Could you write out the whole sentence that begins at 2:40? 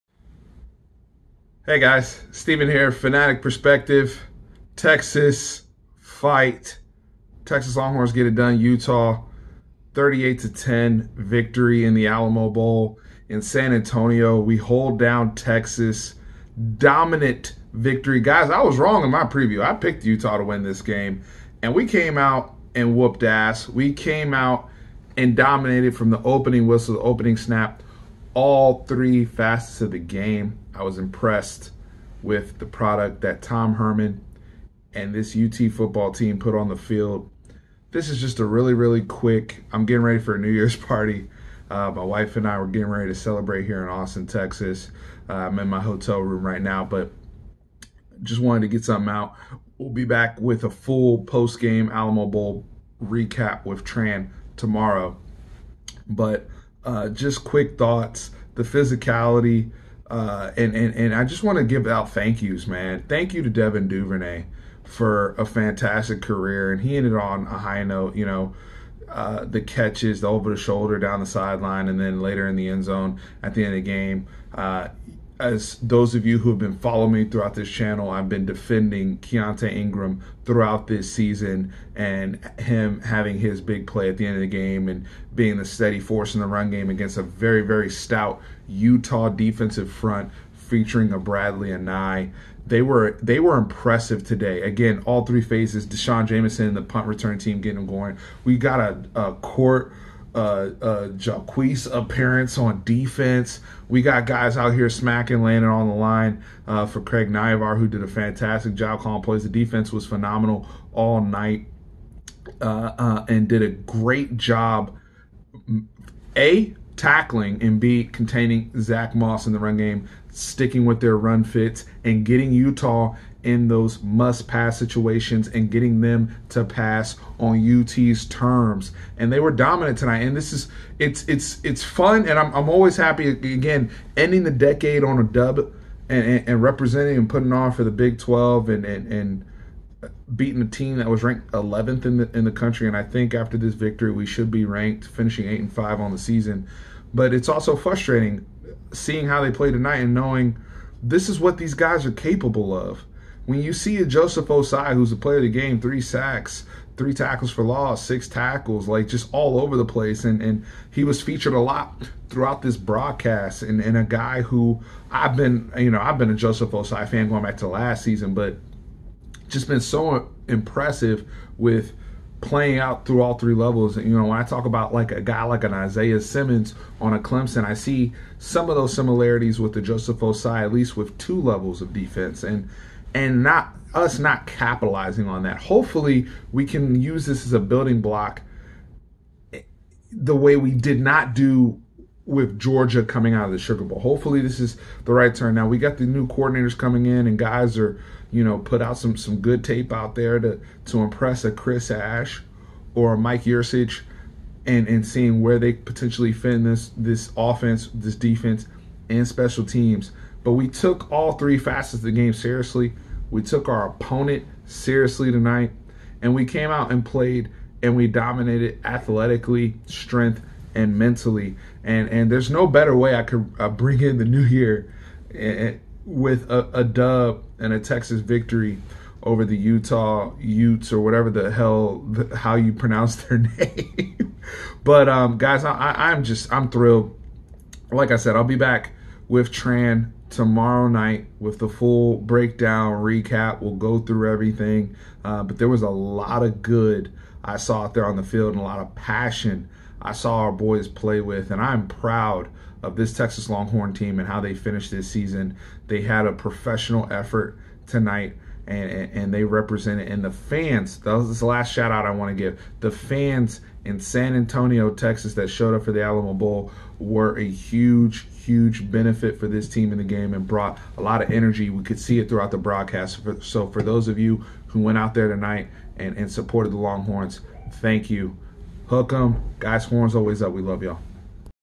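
And and he was featured a lot throughout this broadcast.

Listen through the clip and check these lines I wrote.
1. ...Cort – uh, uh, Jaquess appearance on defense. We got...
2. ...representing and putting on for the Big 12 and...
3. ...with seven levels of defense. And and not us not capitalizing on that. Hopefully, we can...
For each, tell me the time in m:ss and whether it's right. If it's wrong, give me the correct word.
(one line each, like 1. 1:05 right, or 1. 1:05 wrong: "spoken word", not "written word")
1. 1:39 right
2. 2:16 right
3. 3:00 wrong: "two", not "seven".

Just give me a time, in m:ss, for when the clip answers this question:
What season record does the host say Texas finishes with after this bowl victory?
2:25.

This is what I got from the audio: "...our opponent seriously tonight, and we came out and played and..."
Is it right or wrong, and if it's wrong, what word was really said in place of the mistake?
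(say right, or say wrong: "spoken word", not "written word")
right.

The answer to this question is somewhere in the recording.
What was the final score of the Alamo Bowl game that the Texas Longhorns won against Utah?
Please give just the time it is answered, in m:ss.
0:09.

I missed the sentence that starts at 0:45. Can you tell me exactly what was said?
Uh, I'm in my hotel room right now, but just wanted to get something out.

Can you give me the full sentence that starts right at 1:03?
Thank you to Devin Duvernay for a fantastic career, and he ended on a high note, you know.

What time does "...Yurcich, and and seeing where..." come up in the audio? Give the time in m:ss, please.
3:23.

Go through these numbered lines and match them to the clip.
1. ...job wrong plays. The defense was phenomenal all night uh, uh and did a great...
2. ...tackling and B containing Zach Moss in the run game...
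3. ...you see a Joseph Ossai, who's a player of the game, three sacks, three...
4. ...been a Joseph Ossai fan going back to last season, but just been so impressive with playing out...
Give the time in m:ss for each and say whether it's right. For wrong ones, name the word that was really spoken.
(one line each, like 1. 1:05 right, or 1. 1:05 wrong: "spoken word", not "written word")
1. 1:48 wrong: "calling", not "wrong"
2. 1:56 right
3. 2:33 right
4. 2:46 right.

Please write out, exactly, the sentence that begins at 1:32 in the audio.
They were they were impressive today.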